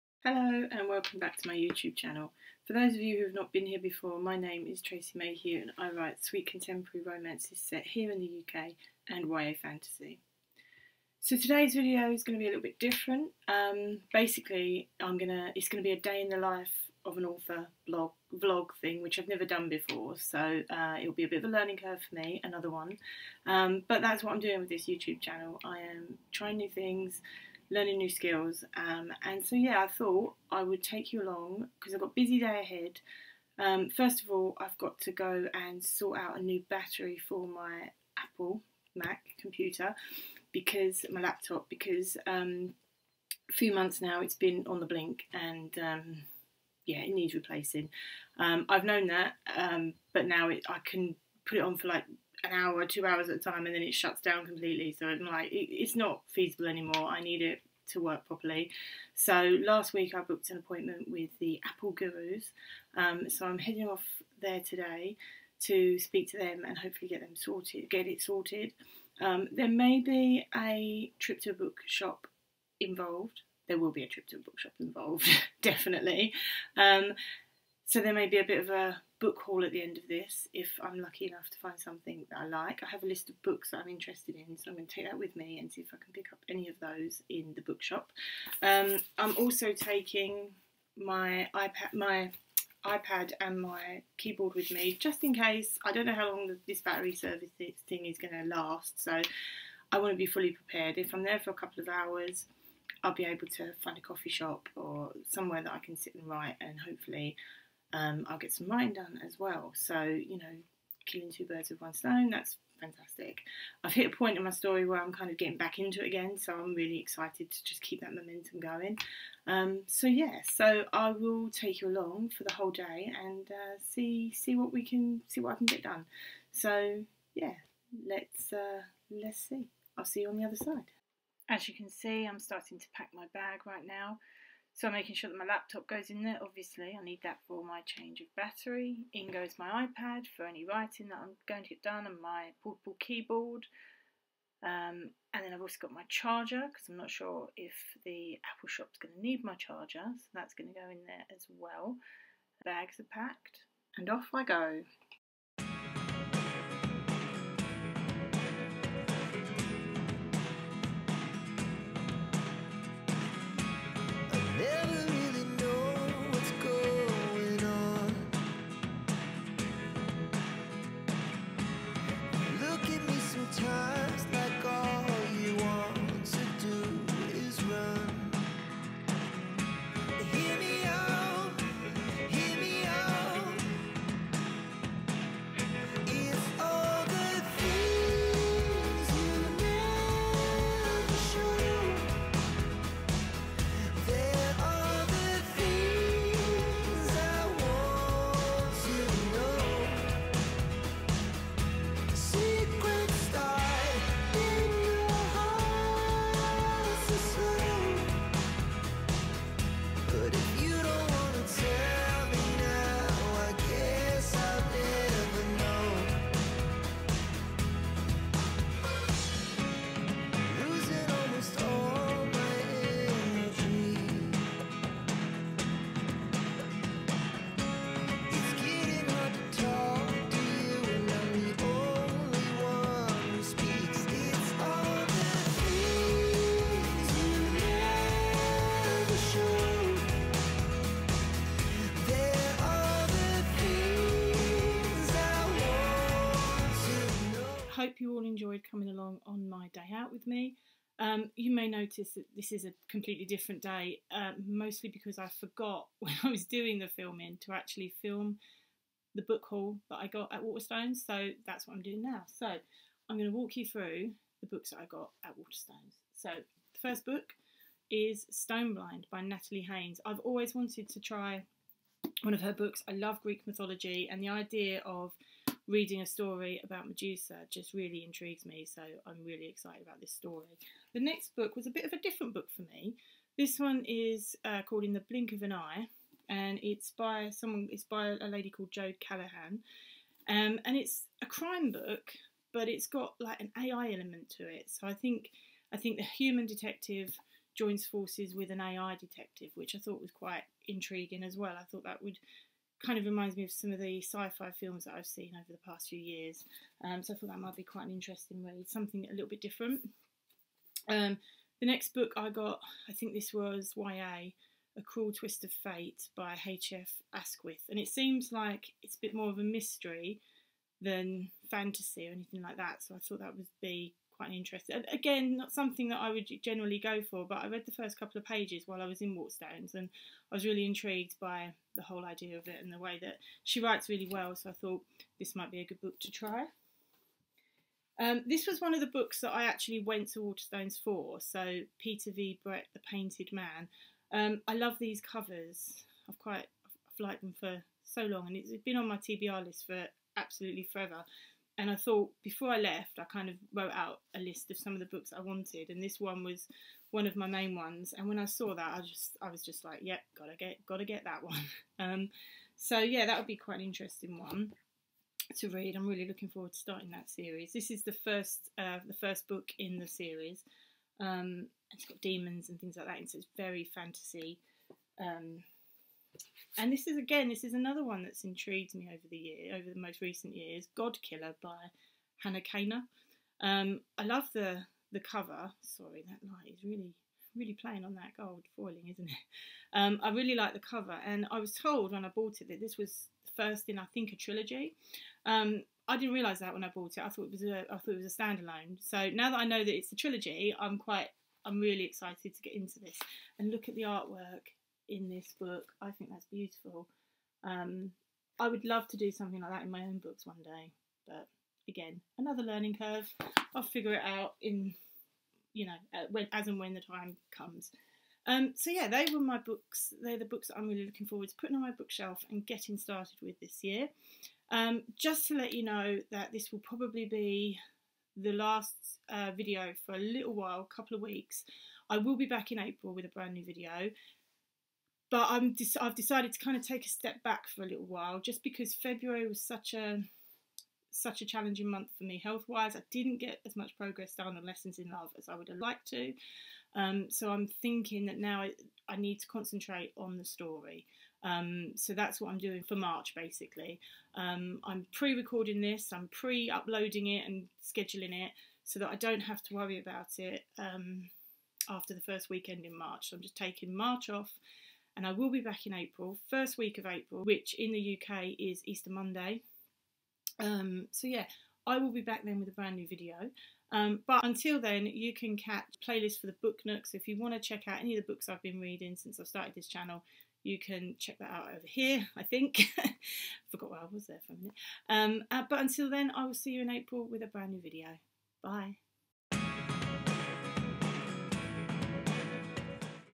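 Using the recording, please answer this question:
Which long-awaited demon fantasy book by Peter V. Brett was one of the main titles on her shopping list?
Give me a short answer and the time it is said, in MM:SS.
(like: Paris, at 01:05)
The Painted Man, at 05:42.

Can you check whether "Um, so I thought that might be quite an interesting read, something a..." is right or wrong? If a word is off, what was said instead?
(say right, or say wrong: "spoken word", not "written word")
right.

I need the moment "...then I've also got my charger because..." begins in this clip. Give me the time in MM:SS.
02:25.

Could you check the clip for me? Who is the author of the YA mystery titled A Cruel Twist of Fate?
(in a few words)
H.F. Asquith.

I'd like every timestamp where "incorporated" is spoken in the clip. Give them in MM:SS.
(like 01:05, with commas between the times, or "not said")
not said.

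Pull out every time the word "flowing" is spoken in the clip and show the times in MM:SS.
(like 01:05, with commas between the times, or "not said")
not said.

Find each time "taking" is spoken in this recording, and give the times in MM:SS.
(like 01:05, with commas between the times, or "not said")
01:29, 07:43.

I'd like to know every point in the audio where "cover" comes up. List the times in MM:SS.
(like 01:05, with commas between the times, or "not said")
05:44, 06:24, 06:30.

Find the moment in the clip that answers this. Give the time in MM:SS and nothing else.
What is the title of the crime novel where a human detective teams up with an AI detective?
04:44.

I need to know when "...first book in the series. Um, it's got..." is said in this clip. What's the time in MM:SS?
06:08.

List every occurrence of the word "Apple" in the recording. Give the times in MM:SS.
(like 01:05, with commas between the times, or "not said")
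00:38, 01:01, 02:28.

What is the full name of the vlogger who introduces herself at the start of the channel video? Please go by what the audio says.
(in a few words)
Tracey Mayhew.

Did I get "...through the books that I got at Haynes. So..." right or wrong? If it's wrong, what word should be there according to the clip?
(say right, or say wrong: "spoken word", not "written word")
wrong: "Waterstones", not "Haynes".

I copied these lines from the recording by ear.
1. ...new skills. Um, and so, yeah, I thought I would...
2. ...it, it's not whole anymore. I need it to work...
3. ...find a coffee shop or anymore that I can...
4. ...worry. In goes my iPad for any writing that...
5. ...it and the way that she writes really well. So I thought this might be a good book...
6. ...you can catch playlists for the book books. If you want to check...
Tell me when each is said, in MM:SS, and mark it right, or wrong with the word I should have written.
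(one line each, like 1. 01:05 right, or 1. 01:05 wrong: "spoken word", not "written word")
1. 00:27 right
2. 00:55 wrong: "feasible", not "whole"
3. 01:43 wrong: "somewhere", not "anymore"
4. 02:18 wrong: "battery", not "worry"
5. 05:32 right
6. 07:54 wrong: "nooks", not "books".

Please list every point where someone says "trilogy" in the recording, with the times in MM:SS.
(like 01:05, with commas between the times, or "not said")
06:34, 06:39.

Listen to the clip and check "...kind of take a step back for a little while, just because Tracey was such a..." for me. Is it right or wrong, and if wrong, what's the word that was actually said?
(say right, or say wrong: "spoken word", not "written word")
wrong: "February", not "Tracey".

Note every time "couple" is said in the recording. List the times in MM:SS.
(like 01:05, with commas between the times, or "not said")
01:41, 05:27, 07:10.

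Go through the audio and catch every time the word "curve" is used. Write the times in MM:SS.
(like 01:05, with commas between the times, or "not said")
00:21, 06:52.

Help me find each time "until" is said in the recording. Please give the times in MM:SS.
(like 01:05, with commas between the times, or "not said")
07:54, 08:05.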